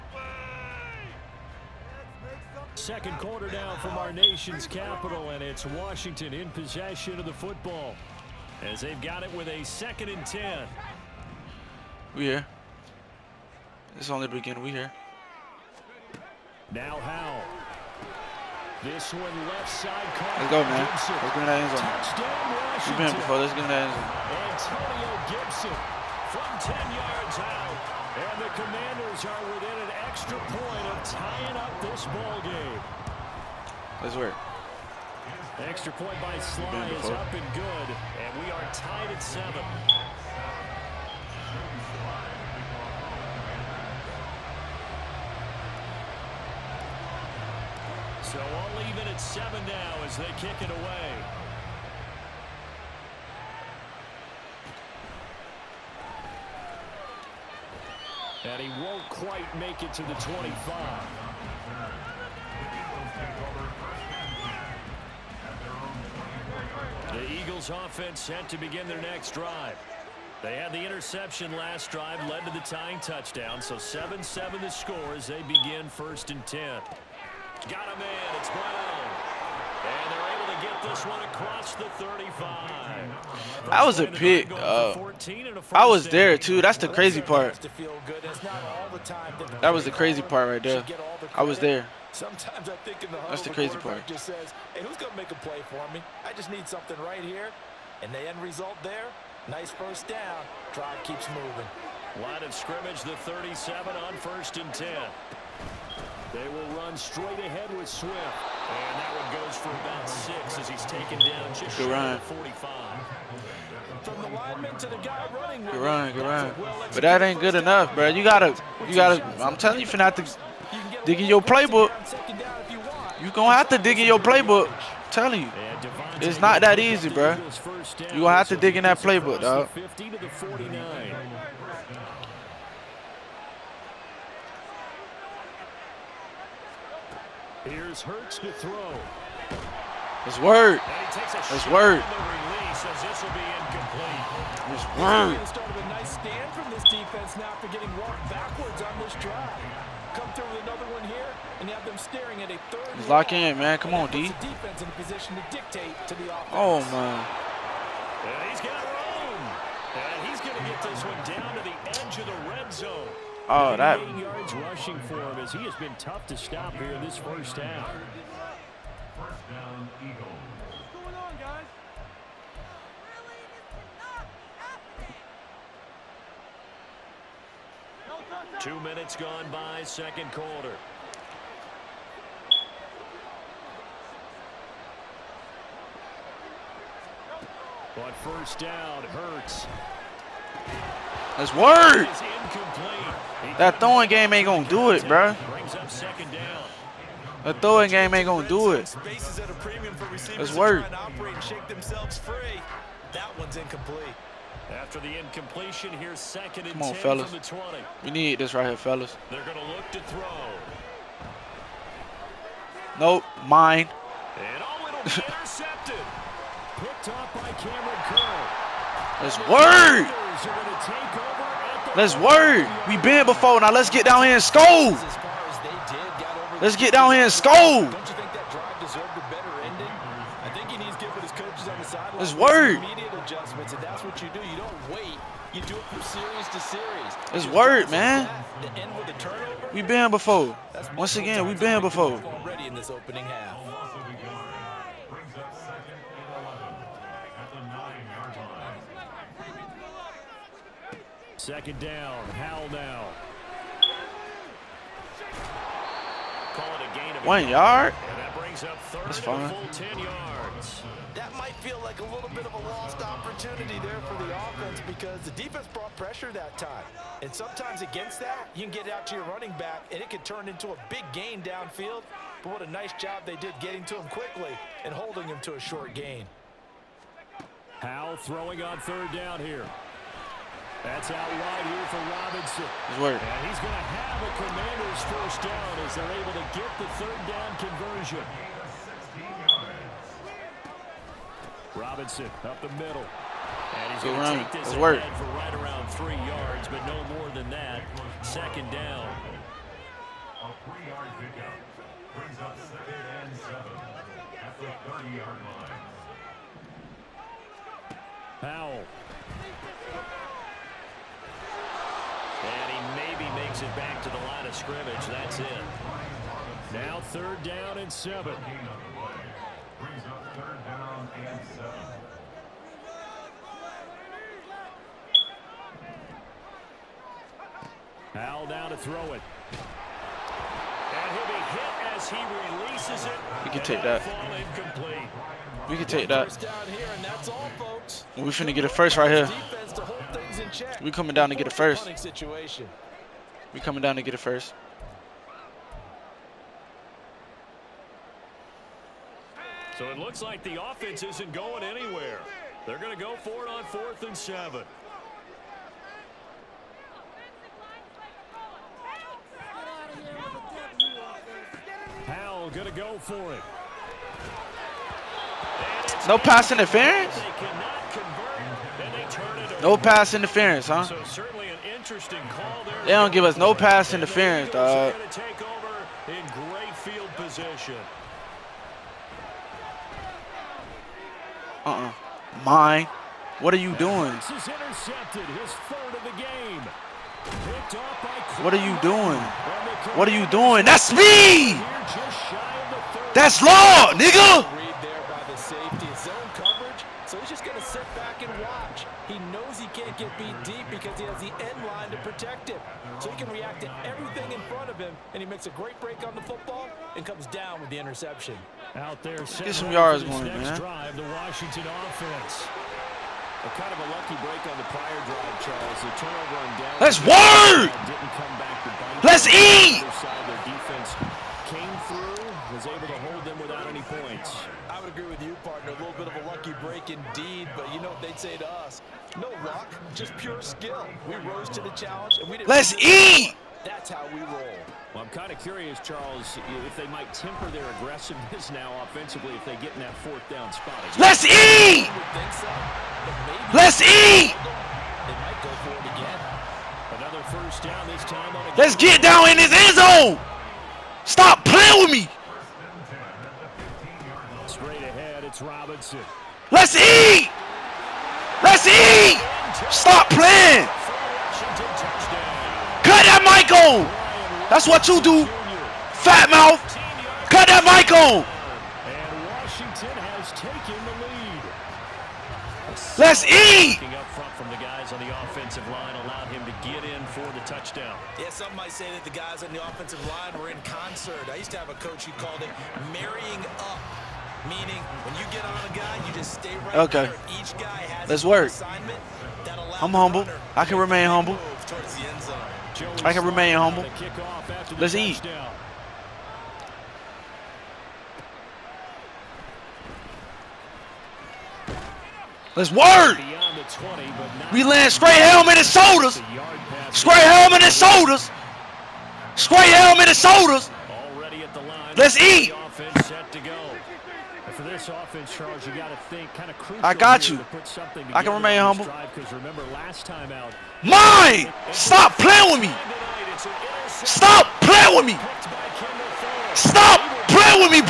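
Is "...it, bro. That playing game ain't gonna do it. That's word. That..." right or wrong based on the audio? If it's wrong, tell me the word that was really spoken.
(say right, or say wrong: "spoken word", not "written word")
wrong: "throwing", not "playing".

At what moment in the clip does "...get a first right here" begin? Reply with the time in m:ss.
5:38.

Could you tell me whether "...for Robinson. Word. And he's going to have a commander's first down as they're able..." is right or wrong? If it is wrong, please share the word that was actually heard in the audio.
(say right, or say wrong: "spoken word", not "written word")
right.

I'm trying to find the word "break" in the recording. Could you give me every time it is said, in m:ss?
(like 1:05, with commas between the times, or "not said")
6:45, 6:54, 7:06.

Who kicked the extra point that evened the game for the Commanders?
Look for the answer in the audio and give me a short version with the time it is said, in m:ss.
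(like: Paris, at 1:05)
Slye, at 0:36.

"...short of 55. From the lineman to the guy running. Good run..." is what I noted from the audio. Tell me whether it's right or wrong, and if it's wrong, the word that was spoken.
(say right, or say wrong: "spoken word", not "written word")
wrong: "45", not "55".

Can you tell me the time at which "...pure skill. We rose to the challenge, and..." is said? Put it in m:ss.
7:10.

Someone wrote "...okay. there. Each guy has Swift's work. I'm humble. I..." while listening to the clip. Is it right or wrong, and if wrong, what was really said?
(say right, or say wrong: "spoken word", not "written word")
wrong: "Let", not "Swift".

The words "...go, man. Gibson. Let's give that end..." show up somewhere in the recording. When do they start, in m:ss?
0:20.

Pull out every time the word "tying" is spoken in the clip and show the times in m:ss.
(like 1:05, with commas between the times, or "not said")
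0:31, 1:12.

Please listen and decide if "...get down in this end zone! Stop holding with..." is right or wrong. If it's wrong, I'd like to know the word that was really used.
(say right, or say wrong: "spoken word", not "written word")
wrong: "playing", not "holding".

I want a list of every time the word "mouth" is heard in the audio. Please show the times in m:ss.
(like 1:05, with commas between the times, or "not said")
7:46.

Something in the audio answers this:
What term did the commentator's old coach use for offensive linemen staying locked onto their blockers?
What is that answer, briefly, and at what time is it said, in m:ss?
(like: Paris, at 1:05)
marrying up, at 8:02.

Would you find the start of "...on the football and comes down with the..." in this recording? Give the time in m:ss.
6:46.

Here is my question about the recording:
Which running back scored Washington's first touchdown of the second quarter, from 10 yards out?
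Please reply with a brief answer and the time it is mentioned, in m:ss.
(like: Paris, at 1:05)
Antonio Gibson, at 0:24.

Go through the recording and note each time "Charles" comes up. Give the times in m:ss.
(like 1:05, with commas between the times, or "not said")
6:55, 7:15, 8:35.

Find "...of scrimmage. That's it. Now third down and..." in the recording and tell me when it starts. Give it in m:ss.
5:14.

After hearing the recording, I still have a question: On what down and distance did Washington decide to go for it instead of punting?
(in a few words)
fourth and seven.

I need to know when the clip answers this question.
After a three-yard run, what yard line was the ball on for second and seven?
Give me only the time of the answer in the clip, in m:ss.
5:04.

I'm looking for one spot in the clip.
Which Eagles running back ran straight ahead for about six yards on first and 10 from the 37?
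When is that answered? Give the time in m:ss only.
1:47.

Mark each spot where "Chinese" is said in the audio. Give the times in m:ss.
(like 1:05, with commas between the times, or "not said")
not said.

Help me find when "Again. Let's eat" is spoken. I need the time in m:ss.
7:20.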